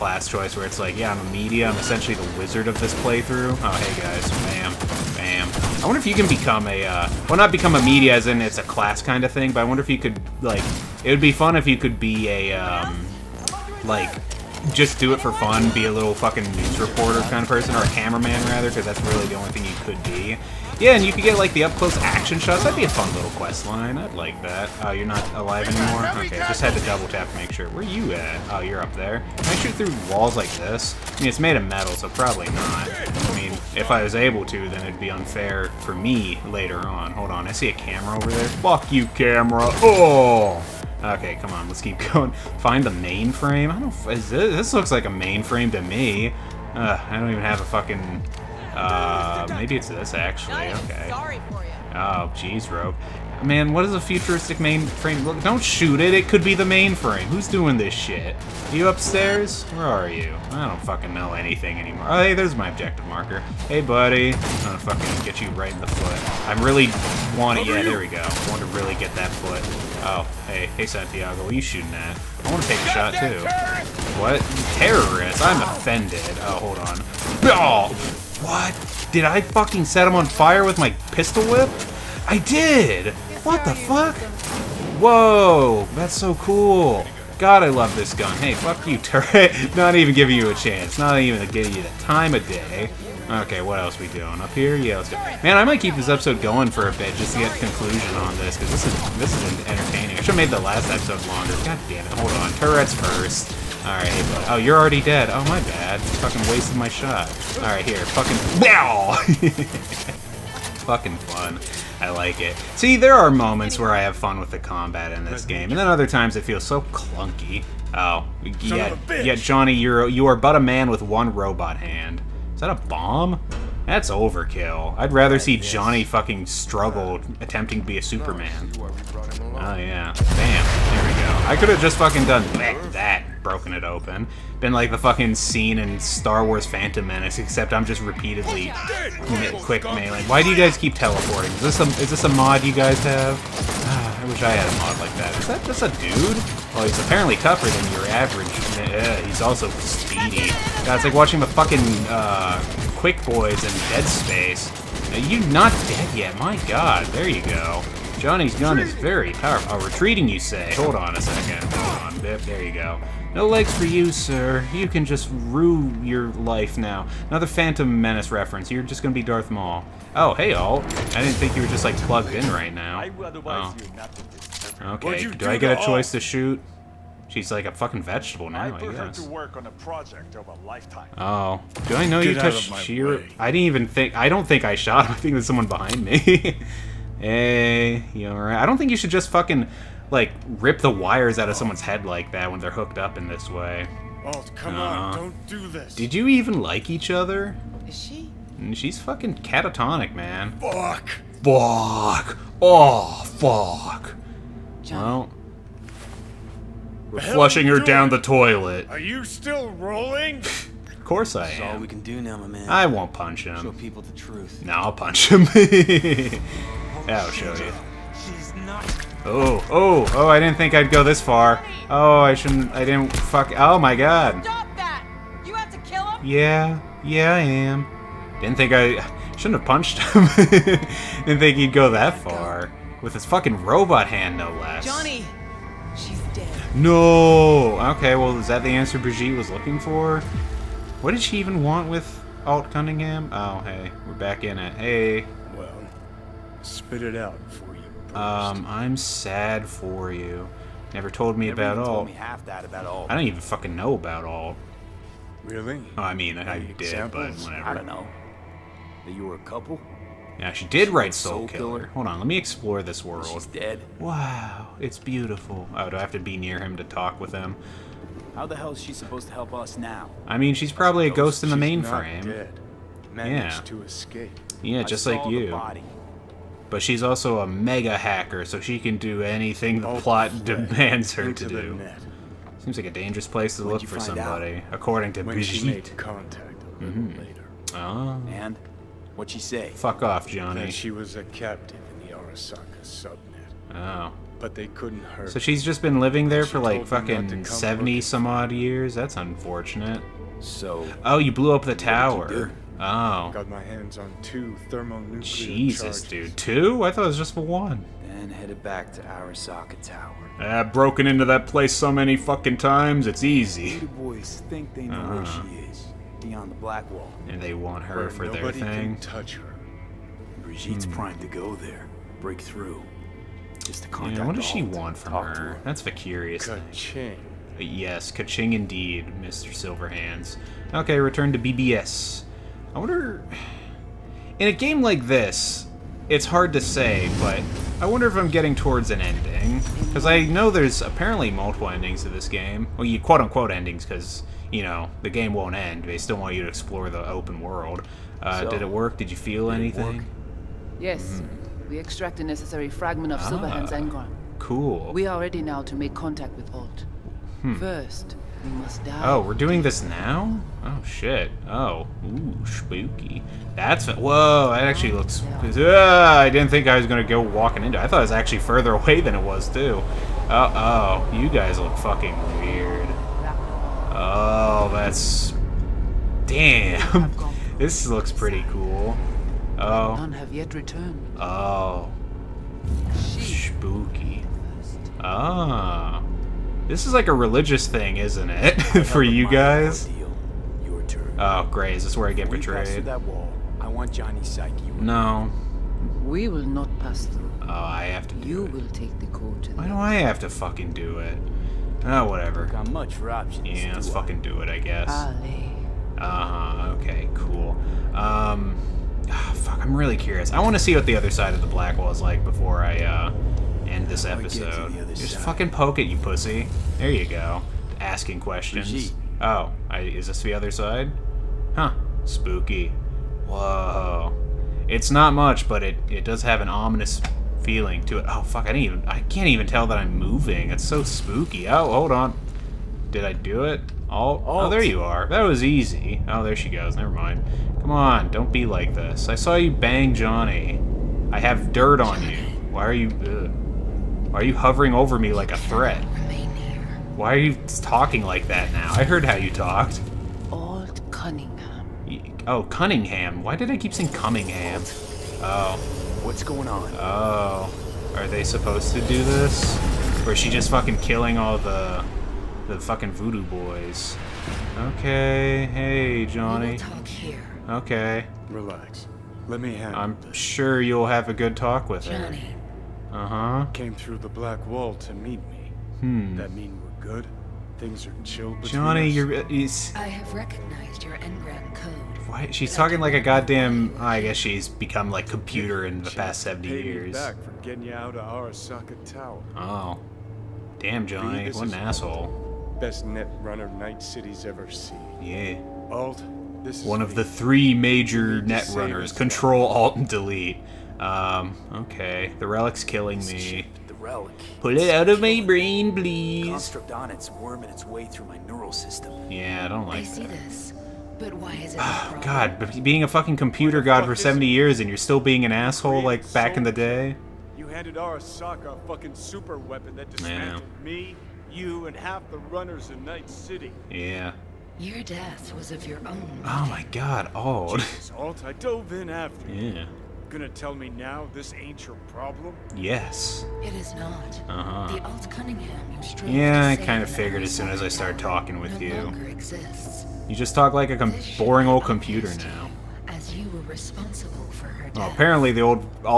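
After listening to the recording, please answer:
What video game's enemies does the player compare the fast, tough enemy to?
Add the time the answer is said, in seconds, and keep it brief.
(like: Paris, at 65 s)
Dead Space, at 153 s.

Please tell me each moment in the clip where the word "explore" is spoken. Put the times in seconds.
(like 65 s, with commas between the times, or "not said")
262 s, 346 s.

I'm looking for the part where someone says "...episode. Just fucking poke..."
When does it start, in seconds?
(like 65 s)
414 s.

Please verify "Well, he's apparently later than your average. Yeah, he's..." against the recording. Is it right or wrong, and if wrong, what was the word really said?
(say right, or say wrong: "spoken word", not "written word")
wrong: "tougher", not "later".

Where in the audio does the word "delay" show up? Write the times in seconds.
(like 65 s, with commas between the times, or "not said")
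not said.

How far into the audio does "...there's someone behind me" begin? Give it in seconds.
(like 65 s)
185 s.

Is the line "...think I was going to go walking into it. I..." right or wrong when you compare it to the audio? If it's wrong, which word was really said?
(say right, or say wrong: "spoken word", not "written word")
right.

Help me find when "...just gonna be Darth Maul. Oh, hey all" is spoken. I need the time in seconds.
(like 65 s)
168 s.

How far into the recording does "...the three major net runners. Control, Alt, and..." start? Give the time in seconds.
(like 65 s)
496 s.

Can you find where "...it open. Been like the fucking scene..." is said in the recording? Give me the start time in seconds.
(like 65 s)
133 s.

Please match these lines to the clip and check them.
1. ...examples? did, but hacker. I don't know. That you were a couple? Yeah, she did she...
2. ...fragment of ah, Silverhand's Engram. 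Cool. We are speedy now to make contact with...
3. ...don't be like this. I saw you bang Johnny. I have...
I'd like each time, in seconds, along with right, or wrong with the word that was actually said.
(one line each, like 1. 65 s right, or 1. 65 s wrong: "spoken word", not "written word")
1. 256 s wrong: "whatever", not "hacker"
2. 352 s wrong: "ready", not "speedy"
3. 438 s right.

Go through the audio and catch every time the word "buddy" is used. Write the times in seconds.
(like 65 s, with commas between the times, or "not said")
63 s.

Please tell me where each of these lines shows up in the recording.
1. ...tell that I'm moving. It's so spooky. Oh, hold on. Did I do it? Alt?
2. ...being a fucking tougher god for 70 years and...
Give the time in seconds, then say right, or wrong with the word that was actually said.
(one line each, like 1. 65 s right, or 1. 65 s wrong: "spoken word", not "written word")
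1. 429 s right
2. 512 s wrong: "computer", not "tougher".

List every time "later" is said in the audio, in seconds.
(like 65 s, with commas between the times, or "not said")
36 s, 287 s.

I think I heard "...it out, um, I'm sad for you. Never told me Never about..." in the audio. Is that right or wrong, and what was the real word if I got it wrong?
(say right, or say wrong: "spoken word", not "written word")
right.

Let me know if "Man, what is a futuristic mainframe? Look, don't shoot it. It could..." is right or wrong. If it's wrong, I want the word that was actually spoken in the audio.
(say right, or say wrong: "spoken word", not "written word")
right.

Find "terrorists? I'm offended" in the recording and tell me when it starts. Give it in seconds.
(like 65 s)
74 s.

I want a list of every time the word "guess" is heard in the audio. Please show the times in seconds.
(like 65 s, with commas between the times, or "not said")
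178 s, 404 s, 484 s.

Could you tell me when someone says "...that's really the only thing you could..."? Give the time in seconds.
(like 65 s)
18 s.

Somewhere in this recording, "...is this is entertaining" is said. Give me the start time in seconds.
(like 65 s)
98 s.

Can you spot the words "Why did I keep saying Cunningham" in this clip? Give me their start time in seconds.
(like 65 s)
453 s.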